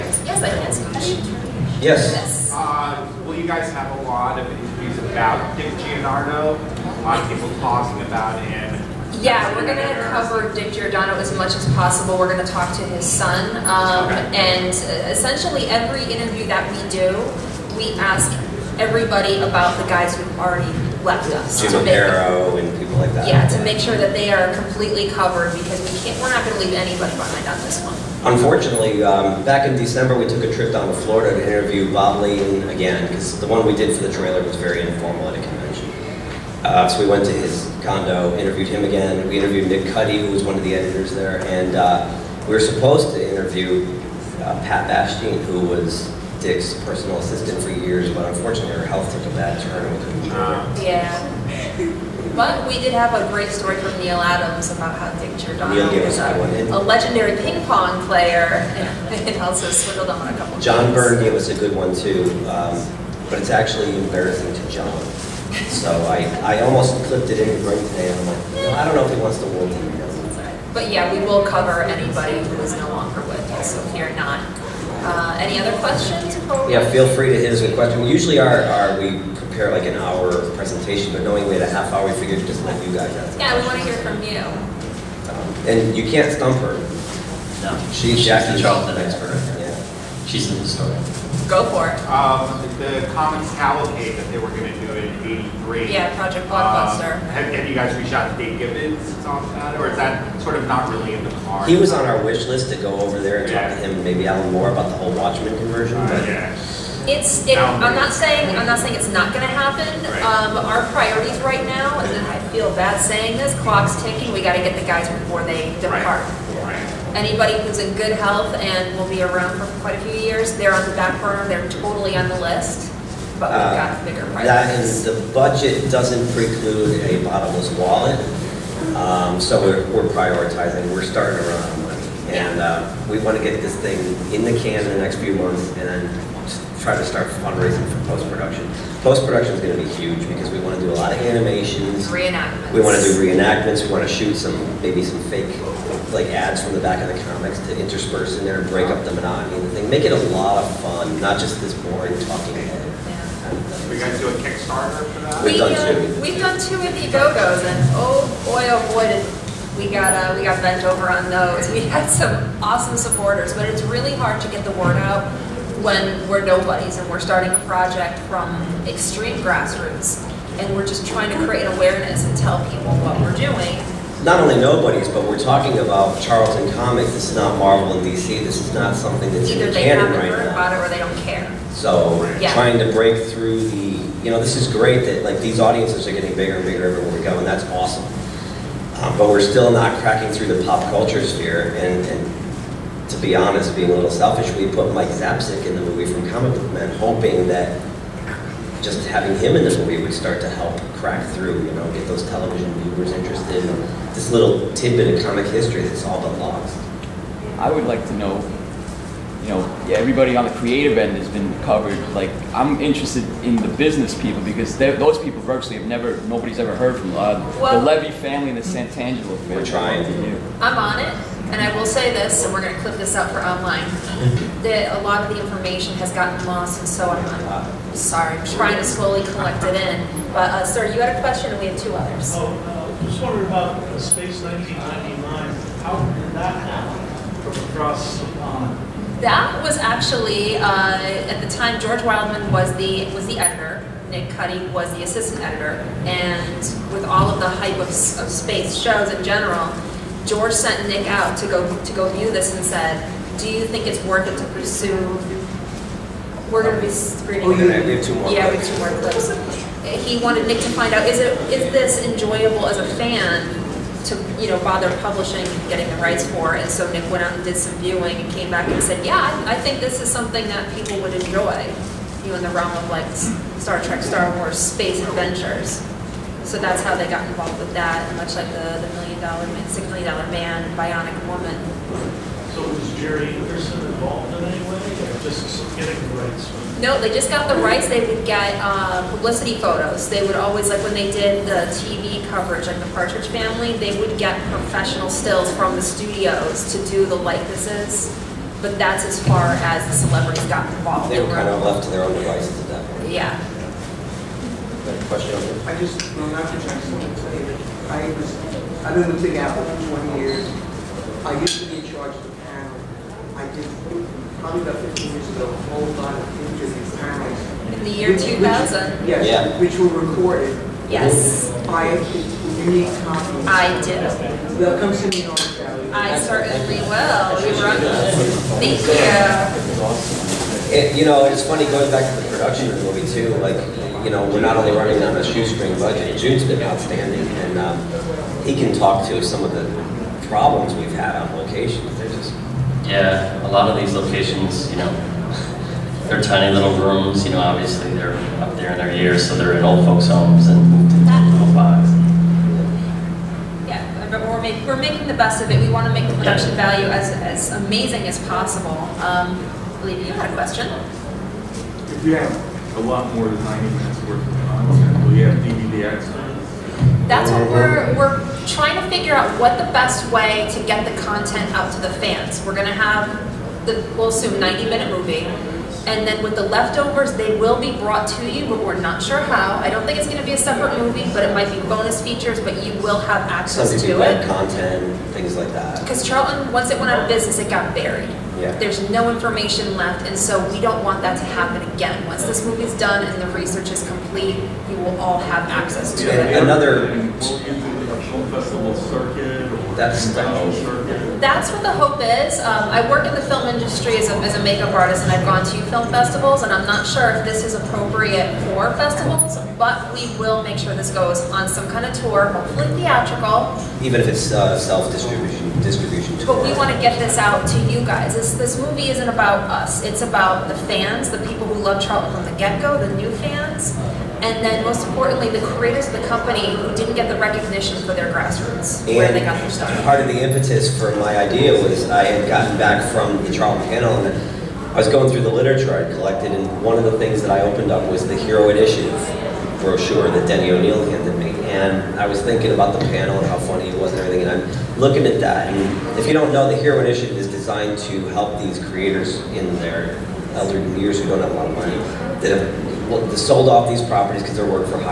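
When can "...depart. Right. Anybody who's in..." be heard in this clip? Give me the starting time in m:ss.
1:55.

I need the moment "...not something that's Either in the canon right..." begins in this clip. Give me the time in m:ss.
2:58.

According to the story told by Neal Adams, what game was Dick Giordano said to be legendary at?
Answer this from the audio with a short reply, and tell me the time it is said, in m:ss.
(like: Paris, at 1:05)
Ping pong, at 0:57.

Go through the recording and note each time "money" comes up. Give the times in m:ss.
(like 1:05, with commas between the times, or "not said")
2:11, 7:31.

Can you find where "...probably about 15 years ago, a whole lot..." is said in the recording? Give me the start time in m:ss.
5:14.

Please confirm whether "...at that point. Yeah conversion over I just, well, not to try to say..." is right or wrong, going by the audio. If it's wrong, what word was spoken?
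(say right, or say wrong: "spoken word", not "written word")
wrong: "question", not "conversion".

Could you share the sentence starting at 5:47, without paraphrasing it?
You know, obviously they're up there in their years, so they're in old folks' homes and little box.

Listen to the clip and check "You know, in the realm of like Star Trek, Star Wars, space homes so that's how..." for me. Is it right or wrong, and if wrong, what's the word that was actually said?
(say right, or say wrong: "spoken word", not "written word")
wrong: "adventures", not "homes".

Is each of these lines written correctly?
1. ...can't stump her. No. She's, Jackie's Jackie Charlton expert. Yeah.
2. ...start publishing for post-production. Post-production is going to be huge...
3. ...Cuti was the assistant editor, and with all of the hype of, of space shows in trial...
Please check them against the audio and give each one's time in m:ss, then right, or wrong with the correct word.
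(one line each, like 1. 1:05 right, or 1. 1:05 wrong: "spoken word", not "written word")
1. 1:26 right
2. 2:17 wrong: "fundraising", not "publishing"
3. 4:04 wrong: "general", not "trial".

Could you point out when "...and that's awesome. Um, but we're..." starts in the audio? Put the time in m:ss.
3:07.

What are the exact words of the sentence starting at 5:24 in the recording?
They'll come to me on I certainly will.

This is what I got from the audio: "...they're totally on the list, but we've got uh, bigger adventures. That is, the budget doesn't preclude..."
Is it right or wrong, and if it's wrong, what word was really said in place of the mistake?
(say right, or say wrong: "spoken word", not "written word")
wrong: "priorities", not "adventures".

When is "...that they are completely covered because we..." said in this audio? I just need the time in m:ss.
0:23.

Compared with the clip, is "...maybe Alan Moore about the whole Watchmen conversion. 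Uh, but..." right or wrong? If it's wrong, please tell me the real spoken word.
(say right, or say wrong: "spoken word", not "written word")
right.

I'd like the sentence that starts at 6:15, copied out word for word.
And then with the leftovers, they will be brought to you, but we're not sure how.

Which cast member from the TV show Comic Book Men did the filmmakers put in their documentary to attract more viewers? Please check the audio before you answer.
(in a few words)
Mike Zapcic.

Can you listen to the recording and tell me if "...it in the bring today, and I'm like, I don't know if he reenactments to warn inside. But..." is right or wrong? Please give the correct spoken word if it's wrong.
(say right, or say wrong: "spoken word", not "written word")
wrong: "wants", not "reenactments".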